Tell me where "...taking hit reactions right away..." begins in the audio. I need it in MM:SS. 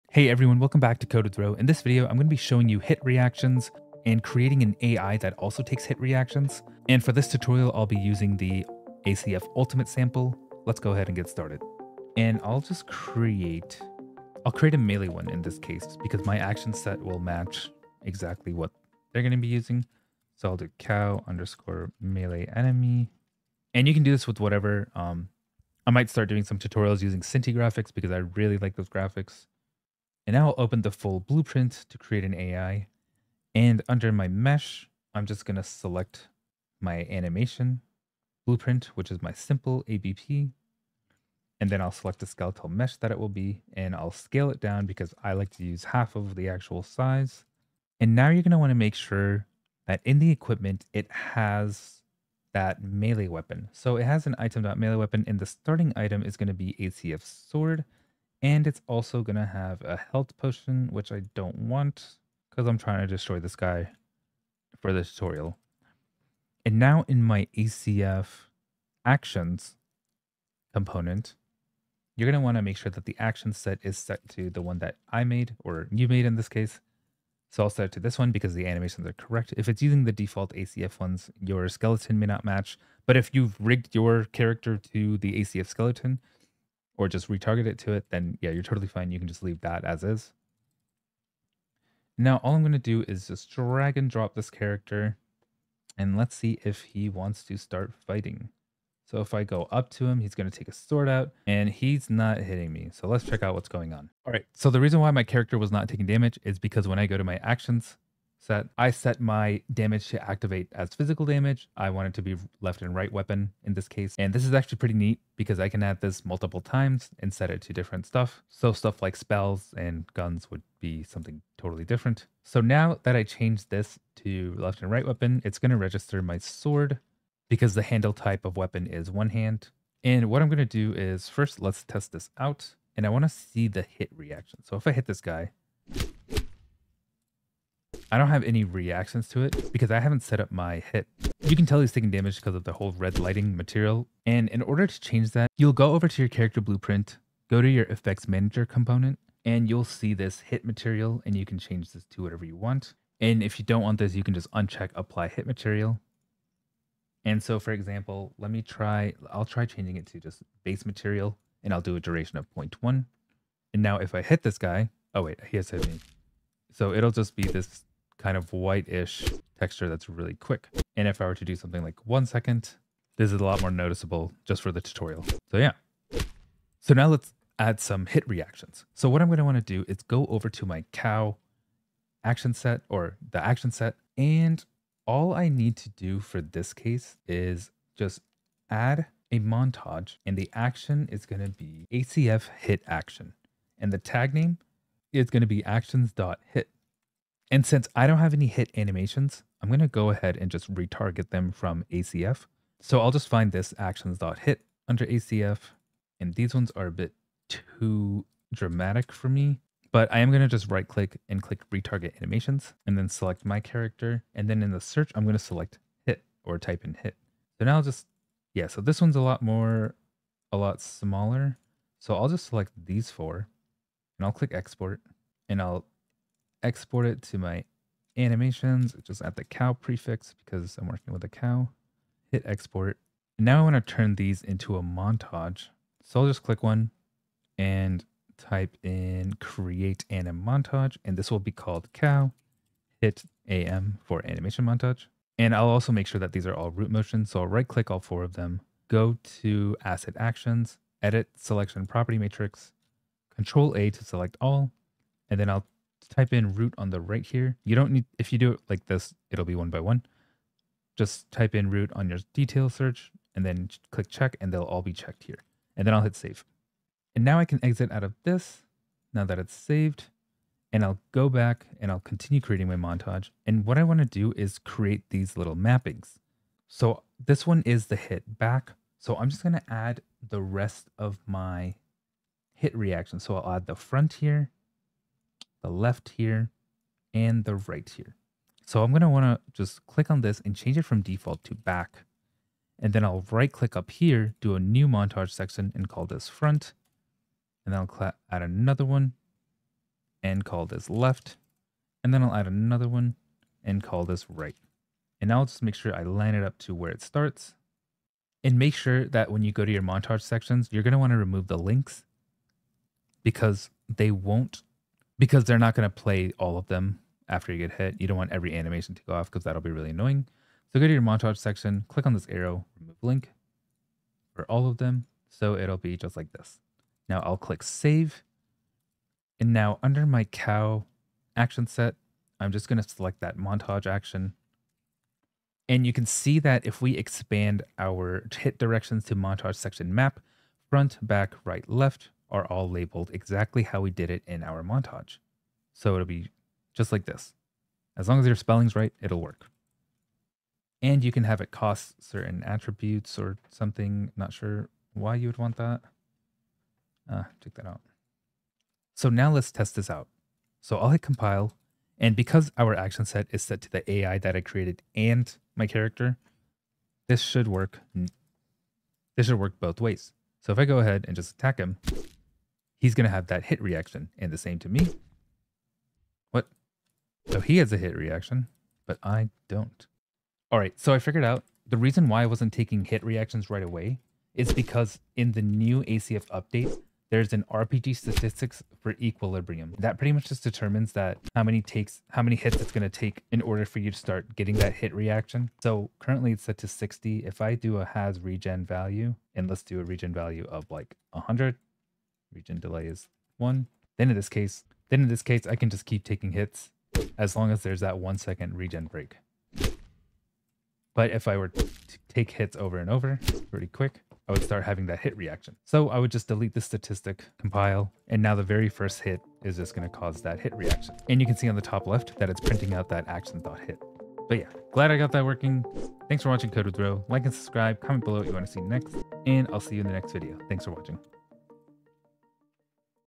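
06:22.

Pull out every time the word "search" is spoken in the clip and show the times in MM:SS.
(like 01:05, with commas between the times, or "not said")
03:34, 04:22.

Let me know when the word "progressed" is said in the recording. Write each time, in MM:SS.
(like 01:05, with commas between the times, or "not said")
not said.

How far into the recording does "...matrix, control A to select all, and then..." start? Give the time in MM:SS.
04:12.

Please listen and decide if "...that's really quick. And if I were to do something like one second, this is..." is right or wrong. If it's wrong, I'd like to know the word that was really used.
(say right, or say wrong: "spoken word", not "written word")
right.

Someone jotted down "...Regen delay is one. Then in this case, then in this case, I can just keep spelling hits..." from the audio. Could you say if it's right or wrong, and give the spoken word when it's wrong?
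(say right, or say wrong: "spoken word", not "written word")
wrong: "taking", not "spelling".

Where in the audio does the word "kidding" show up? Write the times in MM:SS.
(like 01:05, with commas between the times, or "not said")
not said.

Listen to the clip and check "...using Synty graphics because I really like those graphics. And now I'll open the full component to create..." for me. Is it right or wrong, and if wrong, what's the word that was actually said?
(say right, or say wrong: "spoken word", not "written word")
wrong: "blueprint", not "component".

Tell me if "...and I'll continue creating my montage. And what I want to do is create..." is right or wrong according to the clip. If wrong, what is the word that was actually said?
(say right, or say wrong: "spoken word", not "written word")
right.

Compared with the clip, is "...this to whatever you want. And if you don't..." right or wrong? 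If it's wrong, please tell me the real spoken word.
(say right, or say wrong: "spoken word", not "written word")
right.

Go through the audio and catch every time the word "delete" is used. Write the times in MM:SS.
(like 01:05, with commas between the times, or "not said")
06:56.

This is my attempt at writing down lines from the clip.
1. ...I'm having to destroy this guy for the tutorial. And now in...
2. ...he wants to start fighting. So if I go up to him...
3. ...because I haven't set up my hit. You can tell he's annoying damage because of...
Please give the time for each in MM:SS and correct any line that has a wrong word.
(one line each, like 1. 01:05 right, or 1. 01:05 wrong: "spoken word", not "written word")
1. 01:02 wrong: "trying", not "having"
2. 01:36 right
3. 02:19 wrong: "taking", not "annoying".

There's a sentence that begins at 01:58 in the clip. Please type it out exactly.
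So stuff like spells and guns would be something totally different.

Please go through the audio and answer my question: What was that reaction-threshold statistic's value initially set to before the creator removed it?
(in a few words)
60.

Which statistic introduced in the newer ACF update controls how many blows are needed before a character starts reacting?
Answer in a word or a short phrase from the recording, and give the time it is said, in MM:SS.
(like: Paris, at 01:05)
equilibrium, at 06:29.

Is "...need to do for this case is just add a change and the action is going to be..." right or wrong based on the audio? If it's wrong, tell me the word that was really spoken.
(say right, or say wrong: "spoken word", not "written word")
wrong: "montage", not "change".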